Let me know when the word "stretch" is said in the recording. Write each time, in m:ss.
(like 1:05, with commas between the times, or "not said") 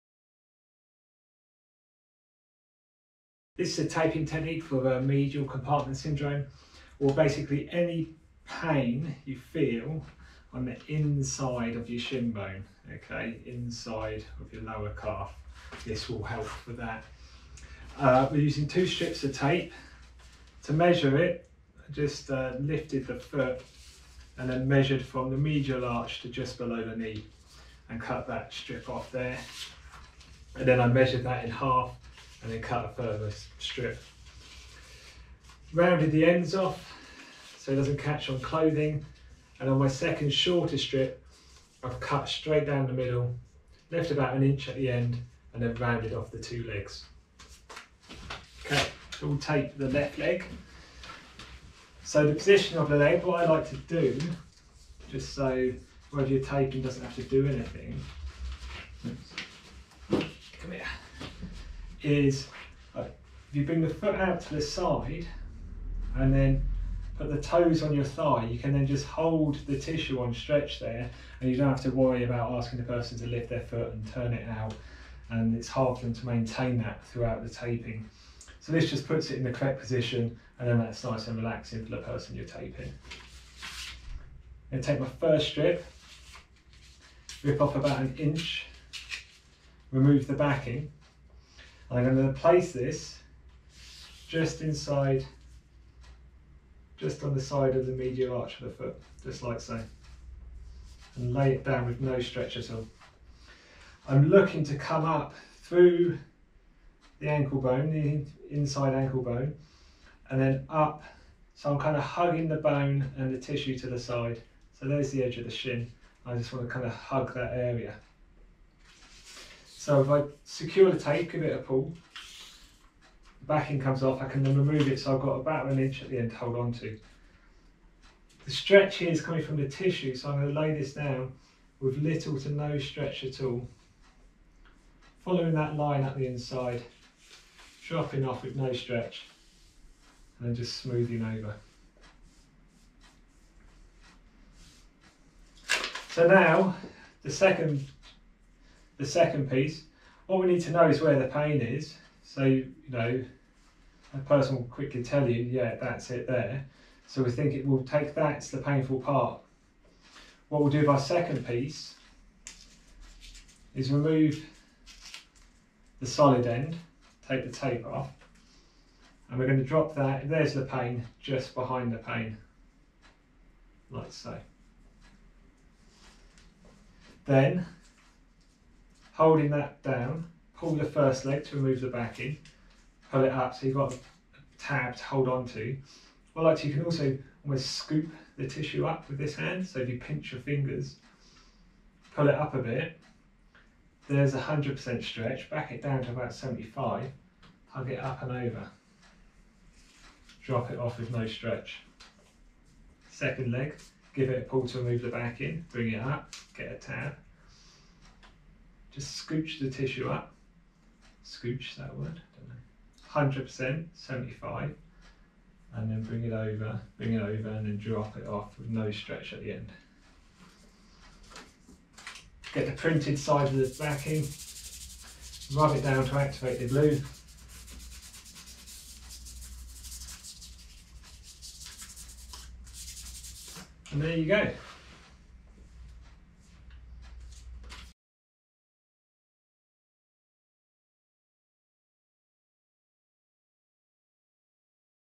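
1:10, 1:42, 2:08, 2:12, 2:18, 3:15, 3:21, 3:38.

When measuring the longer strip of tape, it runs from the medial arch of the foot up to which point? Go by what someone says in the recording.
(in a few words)
Just below the knee.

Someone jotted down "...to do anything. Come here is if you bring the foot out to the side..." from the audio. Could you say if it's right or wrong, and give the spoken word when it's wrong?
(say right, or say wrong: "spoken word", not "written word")
right.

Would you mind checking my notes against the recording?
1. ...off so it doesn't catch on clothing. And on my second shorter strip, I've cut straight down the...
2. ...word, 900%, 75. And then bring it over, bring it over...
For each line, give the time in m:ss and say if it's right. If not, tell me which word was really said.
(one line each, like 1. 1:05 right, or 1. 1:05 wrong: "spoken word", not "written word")
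1. 0:36 right
2. 3:31 wrong: "100", not "900".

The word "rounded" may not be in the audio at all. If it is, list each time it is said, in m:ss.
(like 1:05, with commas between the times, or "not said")
0:35, 0:45.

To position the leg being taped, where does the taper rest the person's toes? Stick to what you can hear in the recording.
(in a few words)
On your thigh.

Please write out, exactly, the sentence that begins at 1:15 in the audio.
And it's hard for them to maintain that throughout the taping.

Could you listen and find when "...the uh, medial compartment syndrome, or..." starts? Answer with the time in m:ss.
0:04.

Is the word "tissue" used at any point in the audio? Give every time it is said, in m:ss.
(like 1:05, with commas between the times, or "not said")
1:09, 1:53, 2:09, 3:08, 3:29.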